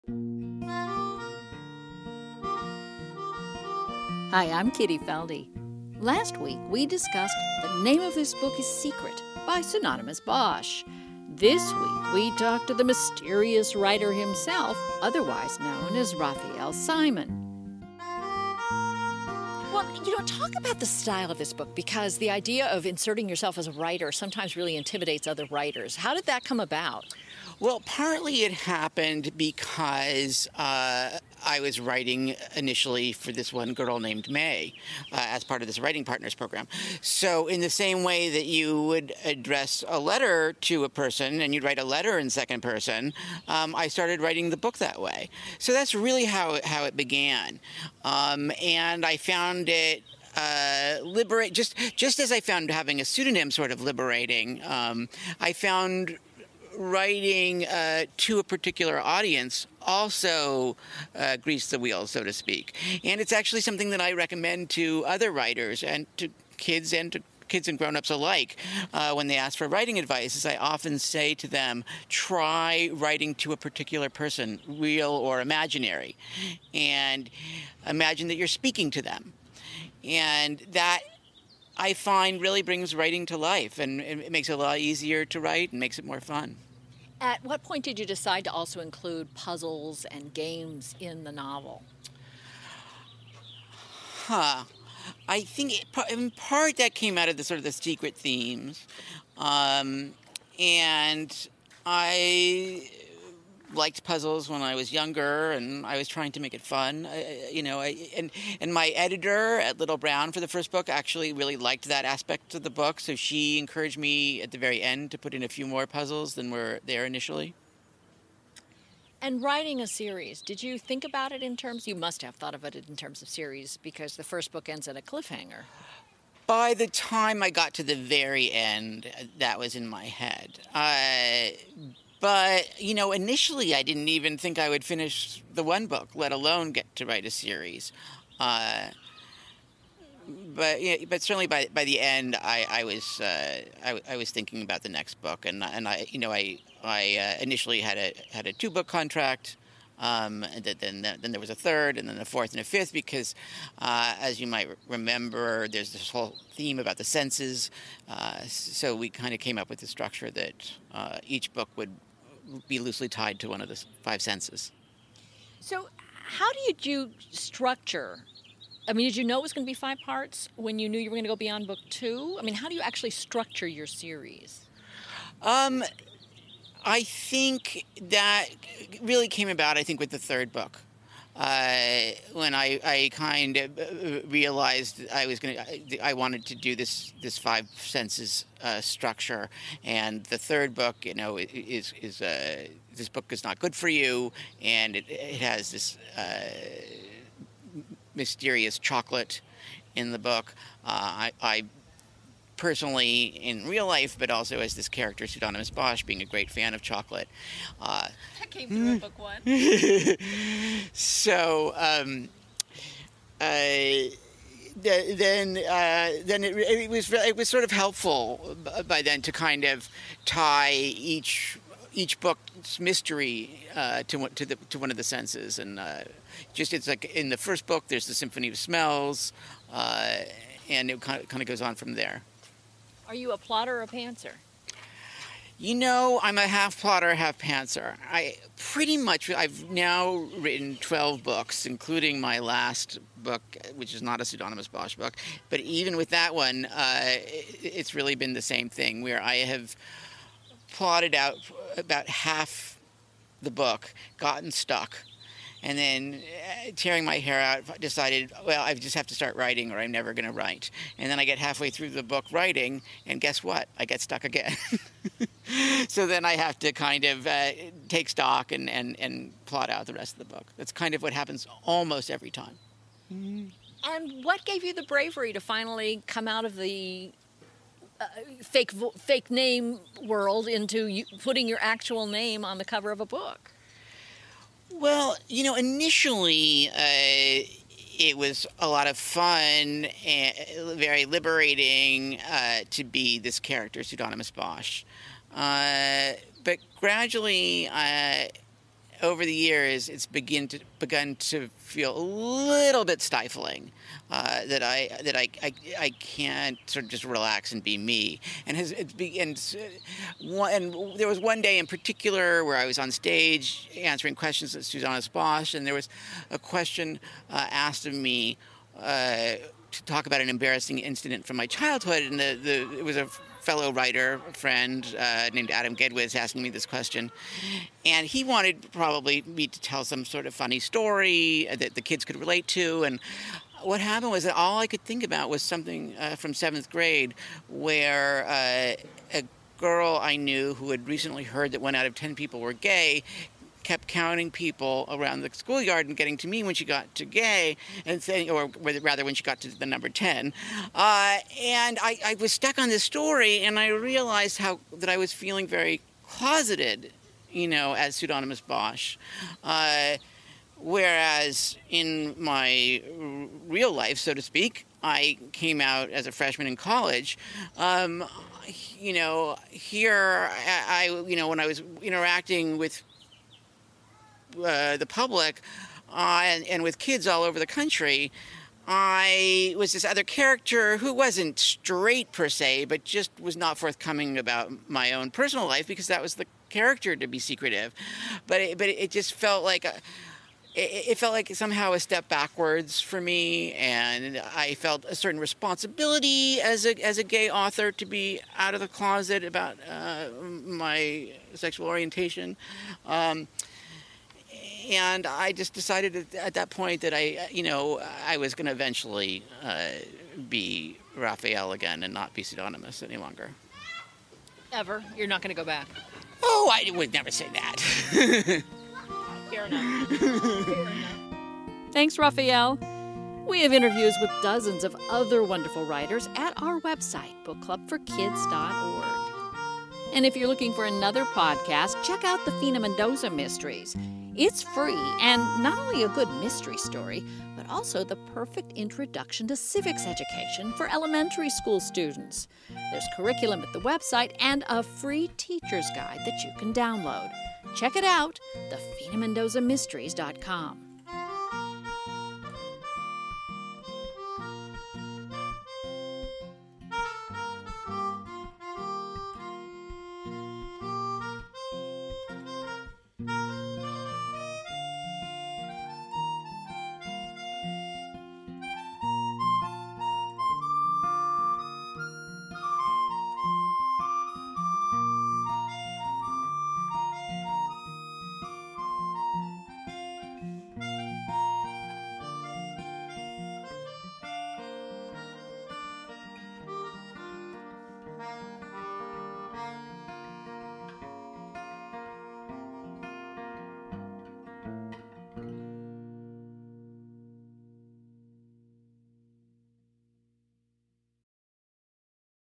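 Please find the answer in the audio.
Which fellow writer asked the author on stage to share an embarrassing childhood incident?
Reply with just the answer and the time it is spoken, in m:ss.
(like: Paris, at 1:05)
Adam Gidwitz, at 5:25.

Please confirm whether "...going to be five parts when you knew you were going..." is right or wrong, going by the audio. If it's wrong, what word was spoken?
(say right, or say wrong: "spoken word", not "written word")
right.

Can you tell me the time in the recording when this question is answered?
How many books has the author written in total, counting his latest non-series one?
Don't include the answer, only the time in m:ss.
4:00.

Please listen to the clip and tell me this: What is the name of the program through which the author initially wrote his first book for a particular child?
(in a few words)
Writing Partners.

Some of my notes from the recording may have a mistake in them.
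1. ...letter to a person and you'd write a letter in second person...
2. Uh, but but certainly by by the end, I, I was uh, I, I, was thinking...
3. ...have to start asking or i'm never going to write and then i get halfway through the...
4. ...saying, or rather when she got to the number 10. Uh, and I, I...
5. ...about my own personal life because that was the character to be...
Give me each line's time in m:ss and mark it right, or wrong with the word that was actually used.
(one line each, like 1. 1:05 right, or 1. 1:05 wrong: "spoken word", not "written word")
1. 0:39 right
2. 2:18 right
3. 4:18 wrong: "writing", not "asking"
4. 5:48 right
5. 6:24 right.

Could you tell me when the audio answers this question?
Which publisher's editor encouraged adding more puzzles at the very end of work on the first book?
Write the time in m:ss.
1:49.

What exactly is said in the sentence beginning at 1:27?
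At what point did you decide to also include puzzles and games in the novel?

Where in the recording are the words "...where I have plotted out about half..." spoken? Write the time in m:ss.
4:09.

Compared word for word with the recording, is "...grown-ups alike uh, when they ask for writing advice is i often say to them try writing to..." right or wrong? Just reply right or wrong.
right.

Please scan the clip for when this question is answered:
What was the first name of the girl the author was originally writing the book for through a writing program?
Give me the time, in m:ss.
0:34.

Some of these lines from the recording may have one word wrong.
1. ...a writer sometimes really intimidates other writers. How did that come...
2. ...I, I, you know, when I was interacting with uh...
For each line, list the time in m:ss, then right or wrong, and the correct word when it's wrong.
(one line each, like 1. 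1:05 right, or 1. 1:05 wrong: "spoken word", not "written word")
1. 0:23 right
2. 6:10 right.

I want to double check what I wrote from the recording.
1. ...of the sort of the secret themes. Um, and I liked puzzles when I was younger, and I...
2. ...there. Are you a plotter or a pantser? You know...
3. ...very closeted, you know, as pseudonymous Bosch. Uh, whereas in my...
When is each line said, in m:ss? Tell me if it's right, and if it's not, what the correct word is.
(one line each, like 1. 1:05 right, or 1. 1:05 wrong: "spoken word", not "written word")
1. 1:37 right
2. 3:51 right
3. 5:55 right.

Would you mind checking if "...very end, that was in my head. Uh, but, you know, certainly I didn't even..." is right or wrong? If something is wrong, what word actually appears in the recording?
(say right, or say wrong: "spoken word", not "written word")
wrong: "initially", not "certainly".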